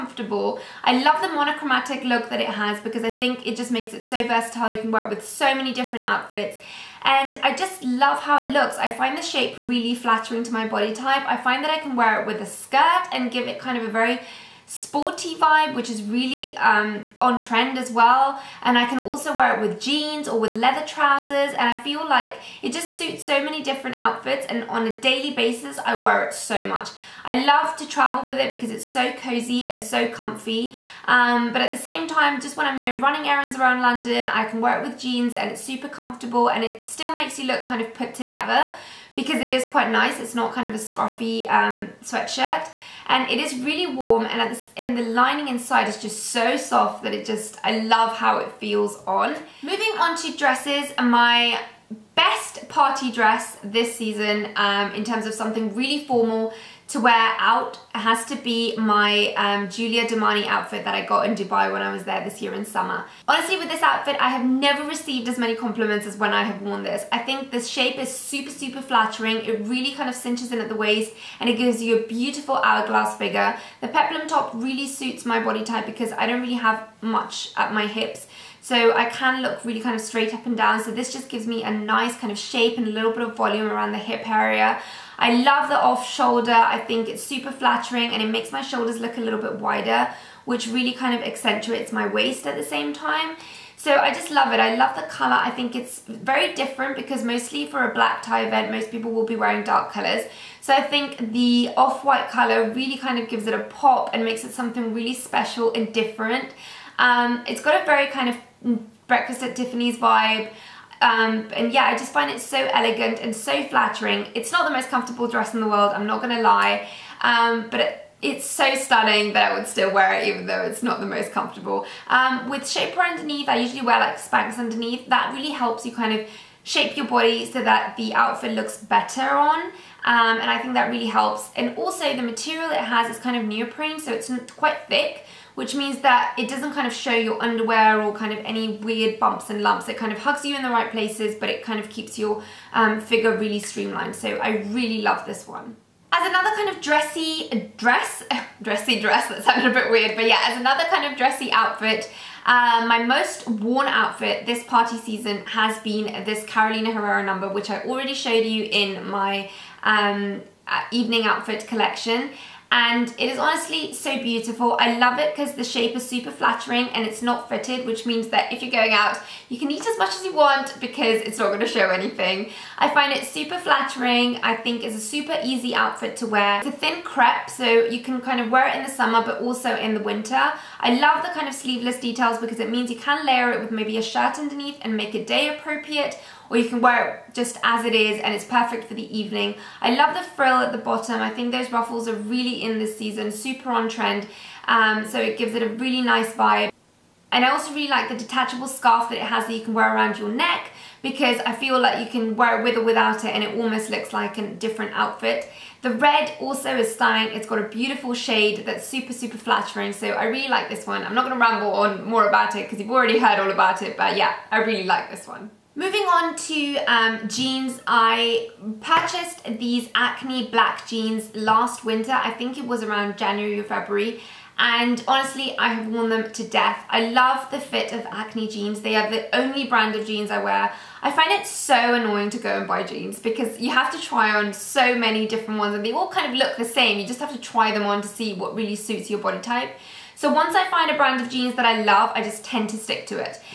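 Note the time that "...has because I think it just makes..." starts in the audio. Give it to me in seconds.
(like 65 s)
2 s.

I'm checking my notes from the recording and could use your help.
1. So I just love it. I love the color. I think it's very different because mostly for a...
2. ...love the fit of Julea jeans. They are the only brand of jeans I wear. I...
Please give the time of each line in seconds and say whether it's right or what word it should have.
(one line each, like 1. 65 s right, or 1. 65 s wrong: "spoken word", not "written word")
1. 93 s right
2. 227 s wrong: "Acne", not "Julea".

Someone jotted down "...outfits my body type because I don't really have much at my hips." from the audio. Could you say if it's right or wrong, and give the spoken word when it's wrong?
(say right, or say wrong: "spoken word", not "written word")
wrong: "suits", not "outfits".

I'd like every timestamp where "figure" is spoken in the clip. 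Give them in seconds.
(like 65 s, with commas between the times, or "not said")
73 s, 142 s.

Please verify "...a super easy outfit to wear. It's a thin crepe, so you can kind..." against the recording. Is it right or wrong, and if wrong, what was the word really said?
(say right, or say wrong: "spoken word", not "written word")
right.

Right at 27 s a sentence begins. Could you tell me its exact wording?
I love to travel with it because it's so cozy and so comfy.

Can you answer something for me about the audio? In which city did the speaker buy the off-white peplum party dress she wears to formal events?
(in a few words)
Dubai.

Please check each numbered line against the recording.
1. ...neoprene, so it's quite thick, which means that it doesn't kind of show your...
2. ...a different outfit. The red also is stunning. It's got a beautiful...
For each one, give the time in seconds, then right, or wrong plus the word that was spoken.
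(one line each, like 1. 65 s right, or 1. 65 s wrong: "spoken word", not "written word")
1. 133 s right
2. 204 s right.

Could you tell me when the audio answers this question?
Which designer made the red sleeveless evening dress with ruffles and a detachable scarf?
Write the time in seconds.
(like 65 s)
156 s.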